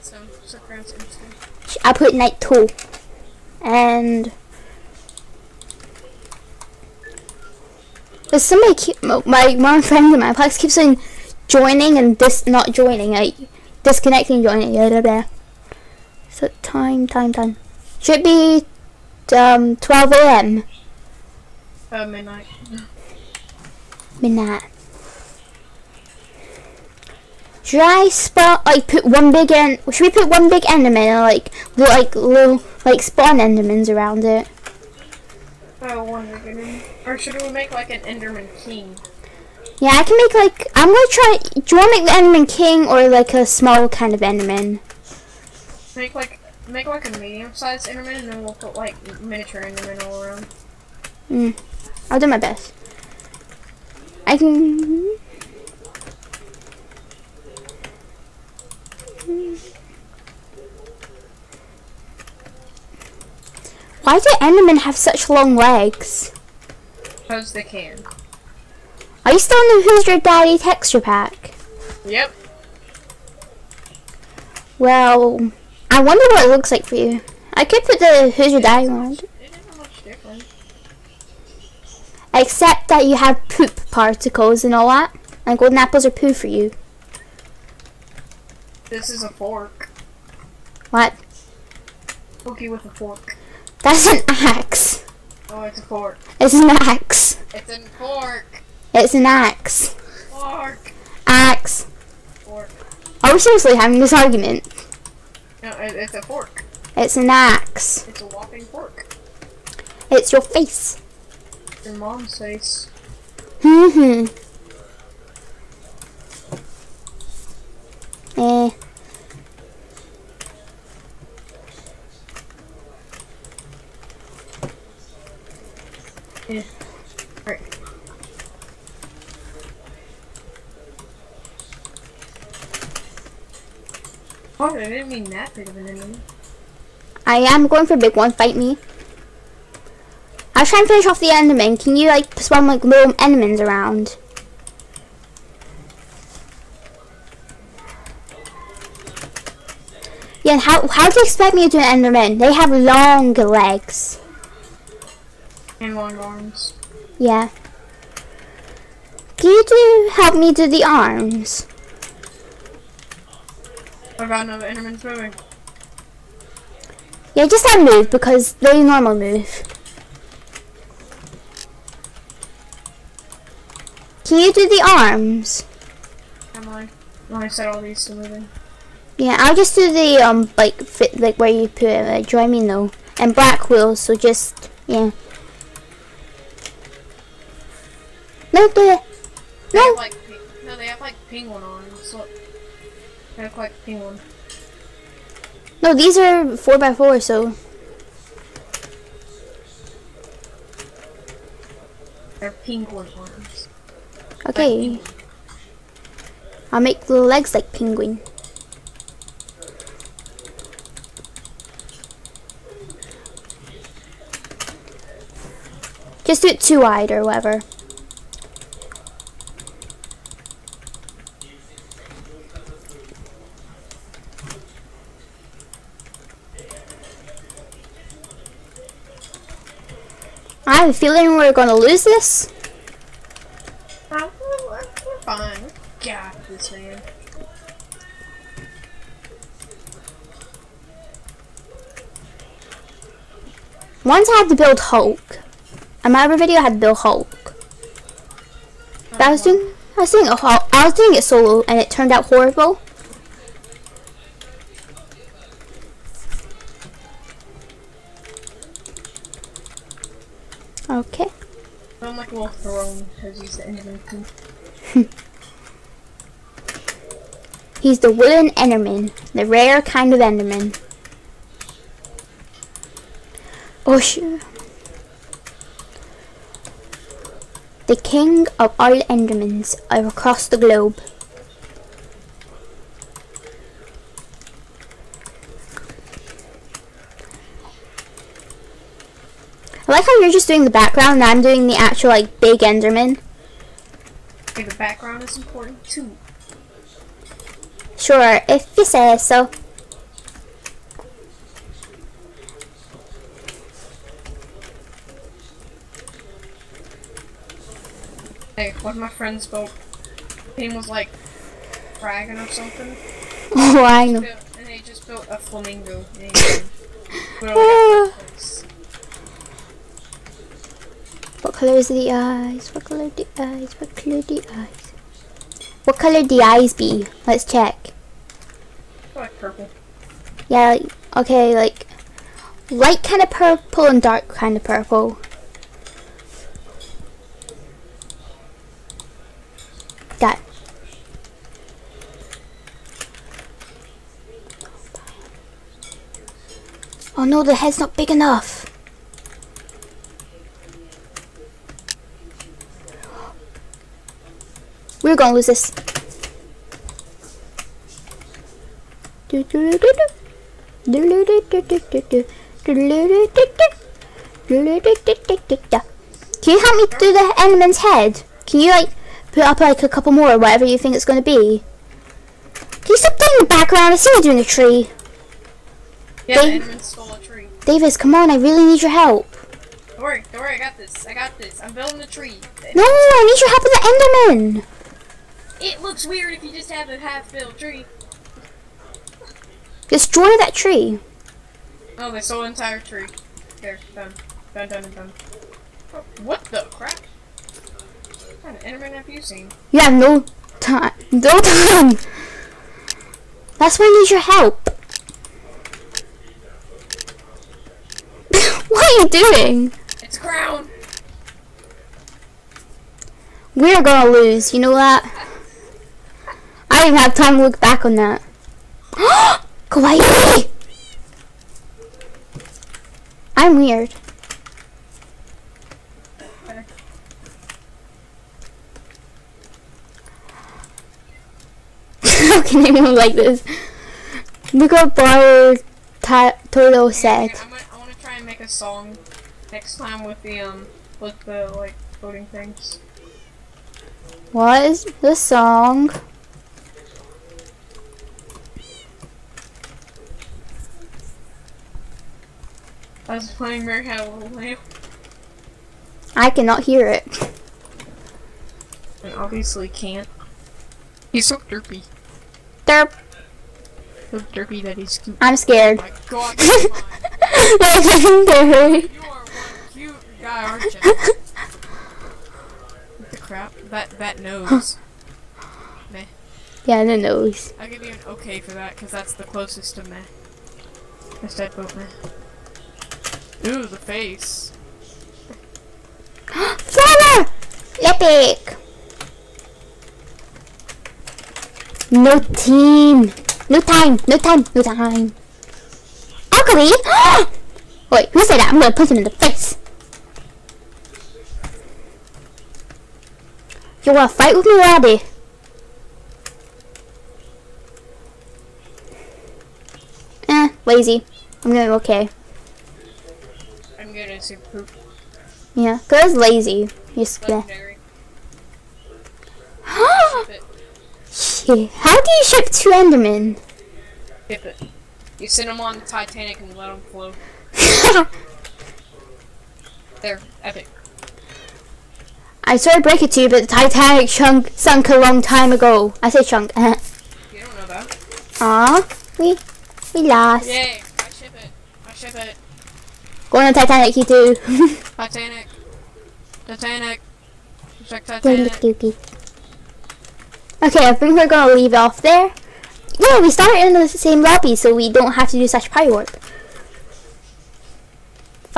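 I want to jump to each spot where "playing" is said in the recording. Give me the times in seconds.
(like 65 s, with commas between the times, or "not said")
373 s, 453 s.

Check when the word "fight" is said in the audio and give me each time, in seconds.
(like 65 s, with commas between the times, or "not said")
138 s, 504 s.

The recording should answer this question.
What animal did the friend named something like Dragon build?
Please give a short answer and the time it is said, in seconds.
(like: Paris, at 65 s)
A flamingo, at 315 s.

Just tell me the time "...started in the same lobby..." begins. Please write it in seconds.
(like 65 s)
553 s.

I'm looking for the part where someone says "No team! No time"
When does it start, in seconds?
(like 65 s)
491 s.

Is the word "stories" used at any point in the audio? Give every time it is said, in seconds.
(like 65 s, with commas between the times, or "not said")
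not said.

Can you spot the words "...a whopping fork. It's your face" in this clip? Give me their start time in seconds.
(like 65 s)
108 s.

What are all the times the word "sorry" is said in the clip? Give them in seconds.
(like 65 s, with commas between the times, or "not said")
532 s.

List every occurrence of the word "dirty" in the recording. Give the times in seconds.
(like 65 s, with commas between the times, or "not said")
not said.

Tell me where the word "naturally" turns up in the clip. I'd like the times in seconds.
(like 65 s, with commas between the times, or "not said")
not said.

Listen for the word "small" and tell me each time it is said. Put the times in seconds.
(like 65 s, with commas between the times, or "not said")
43 s.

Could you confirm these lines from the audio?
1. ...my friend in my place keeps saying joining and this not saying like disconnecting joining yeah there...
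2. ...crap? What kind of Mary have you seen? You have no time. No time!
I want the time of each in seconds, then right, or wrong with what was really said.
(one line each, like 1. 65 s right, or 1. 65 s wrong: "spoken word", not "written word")
1. 9 s wrong: "joining", not "saying"
2. 396 s wrong: "Enderman", not "Mary".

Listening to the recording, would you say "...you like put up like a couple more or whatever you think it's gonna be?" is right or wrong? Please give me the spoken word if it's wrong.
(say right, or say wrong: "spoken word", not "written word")
right.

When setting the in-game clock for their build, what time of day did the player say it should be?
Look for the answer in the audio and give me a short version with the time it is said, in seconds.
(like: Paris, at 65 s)
Midnight, at 19 s.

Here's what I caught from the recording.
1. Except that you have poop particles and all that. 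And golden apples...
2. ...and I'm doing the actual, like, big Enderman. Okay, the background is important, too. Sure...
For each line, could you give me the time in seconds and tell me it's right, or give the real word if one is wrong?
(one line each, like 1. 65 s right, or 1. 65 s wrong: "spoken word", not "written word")
1. 82 s right
2. 291 s right.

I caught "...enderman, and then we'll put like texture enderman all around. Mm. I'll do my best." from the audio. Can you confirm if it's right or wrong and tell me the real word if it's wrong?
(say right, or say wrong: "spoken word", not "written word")
wrong: "miniature", not "texture".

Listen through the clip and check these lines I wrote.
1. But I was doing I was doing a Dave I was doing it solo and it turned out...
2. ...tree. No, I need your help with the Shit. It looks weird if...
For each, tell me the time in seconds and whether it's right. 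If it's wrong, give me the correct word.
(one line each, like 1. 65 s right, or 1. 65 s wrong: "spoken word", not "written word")
1. 249 s wrong: "Hulk", not "Dave"
2. 382 s wrong: "Enderman", not "Shit".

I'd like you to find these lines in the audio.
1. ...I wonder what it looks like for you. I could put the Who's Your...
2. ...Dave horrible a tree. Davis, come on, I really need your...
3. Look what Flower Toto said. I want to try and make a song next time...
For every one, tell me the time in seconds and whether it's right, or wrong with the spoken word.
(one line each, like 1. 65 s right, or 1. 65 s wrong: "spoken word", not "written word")
1. 75 s right
2. 376 s wrong: "stole", not "horrible"
3. 434 s right.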